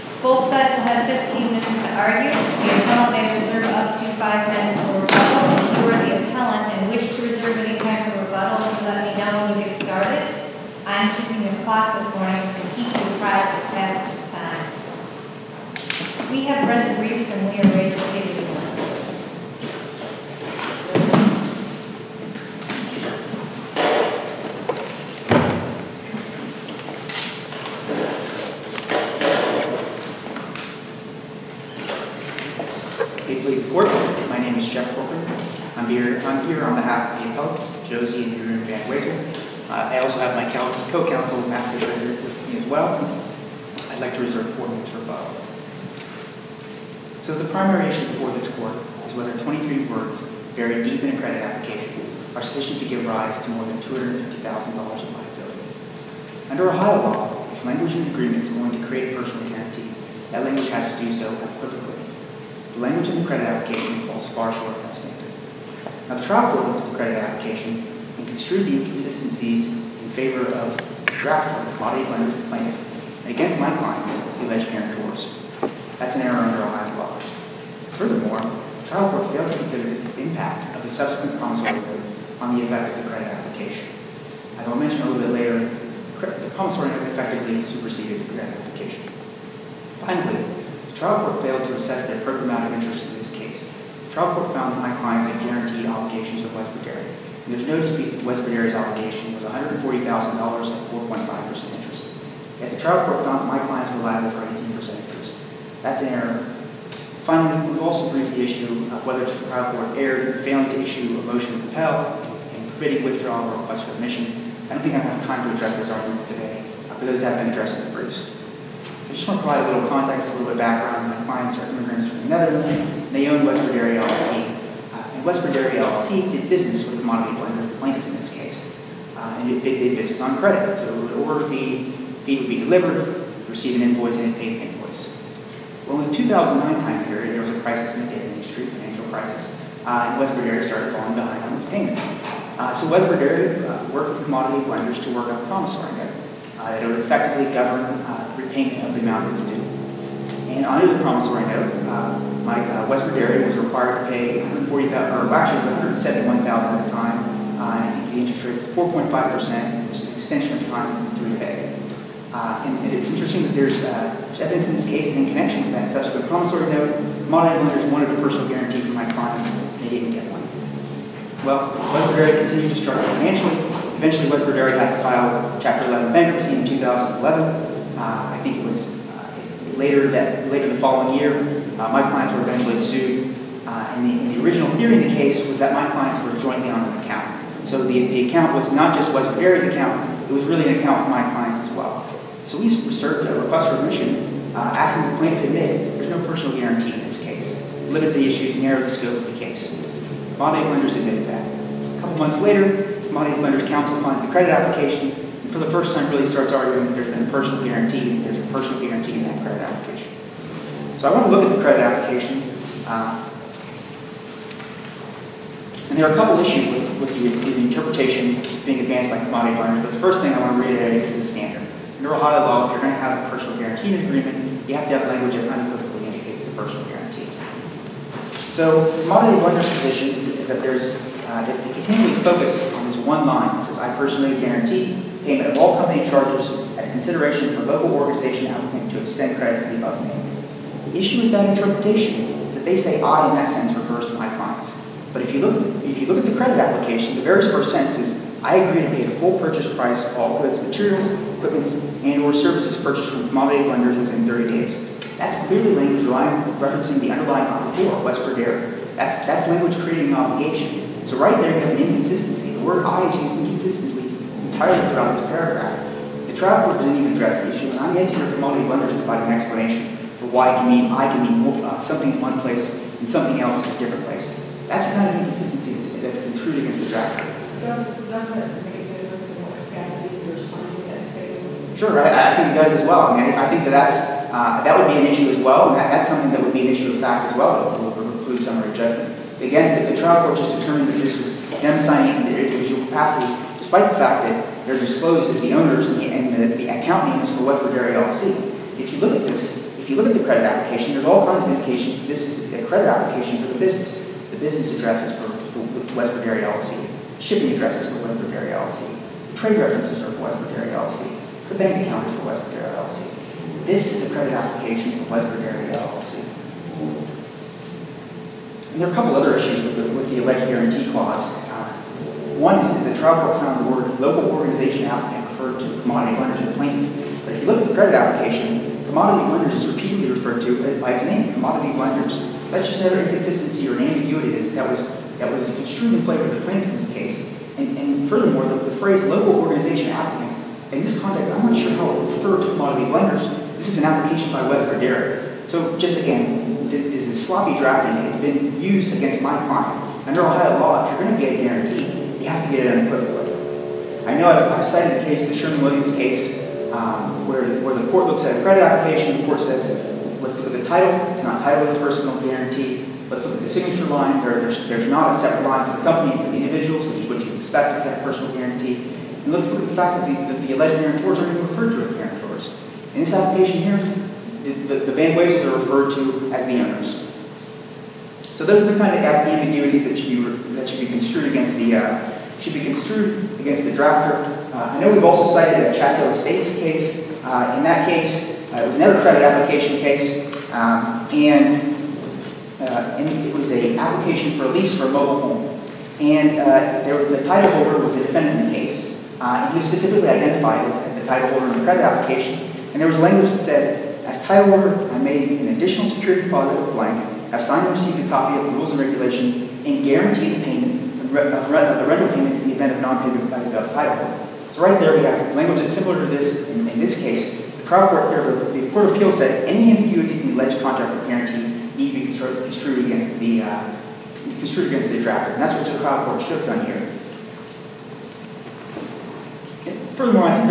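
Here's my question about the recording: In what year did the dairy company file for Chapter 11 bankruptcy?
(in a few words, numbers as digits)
2011.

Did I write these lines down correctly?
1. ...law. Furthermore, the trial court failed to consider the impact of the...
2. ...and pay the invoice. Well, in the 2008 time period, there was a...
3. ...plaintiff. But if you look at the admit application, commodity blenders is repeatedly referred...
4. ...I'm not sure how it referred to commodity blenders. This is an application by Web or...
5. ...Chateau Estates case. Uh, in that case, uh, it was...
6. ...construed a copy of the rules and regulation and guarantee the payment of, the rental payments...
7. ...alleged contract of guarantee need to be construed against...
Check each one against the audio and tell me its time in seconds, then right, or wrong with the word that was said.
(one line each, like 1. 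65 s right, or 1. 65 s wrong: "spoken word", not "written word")
1. 76 s right
2. 134 s wrong: "2009", not "2008"
3. 326 s wrong: "credit", not "admit"
4. 341 s right
5. 385 s right
6. 407 s wrong: "received", not "construed"
7. 420 s right.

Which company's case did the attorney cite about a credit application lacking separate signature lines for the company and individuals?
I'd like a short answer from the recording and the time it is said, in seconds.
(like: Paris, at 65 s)
Sherwin-Williams, at 355 s.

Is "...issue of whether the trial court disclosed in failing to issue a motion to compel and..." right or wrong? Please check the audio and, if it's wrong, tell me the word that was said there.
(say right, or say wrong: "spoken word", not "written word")
wrong: "erred", not "disclosed".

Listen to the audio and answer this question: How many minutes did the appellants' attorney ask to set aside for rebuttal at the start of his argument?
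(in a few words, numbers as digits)
4.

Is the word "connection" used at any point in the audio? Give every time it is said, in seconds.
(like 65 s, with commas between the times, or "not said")
165 s.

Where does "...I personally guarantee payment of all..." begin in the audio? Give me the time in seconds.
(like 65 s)
233 s.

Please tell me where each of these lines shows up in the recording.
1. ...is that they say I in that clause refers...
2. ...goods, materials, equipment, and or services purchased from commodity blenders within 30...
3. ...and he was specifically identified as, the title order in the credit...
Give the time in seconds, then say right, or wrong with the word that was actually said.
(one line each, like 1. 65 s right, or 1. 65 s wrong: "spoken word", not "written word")
1. 242 s wrong: "sense", not "clause"
2. 250 s right
3. 399 s wrong: "holder", not "order".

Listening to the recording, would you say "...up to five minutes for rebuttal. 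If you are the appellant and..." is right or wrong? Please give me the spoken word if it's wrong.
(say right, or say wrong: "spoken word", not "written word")
right.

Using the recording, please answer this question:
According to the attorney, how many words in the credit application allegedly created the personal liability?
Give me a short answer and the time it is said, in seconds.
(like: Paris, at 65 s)
23, at 49 s.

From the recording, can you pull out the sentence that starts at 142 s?
Uh, so Westward Dairy uh, worked with commodity blenders to work out promissory note.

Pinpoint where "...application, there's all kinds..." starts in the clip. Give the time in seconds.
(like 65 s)
300 s.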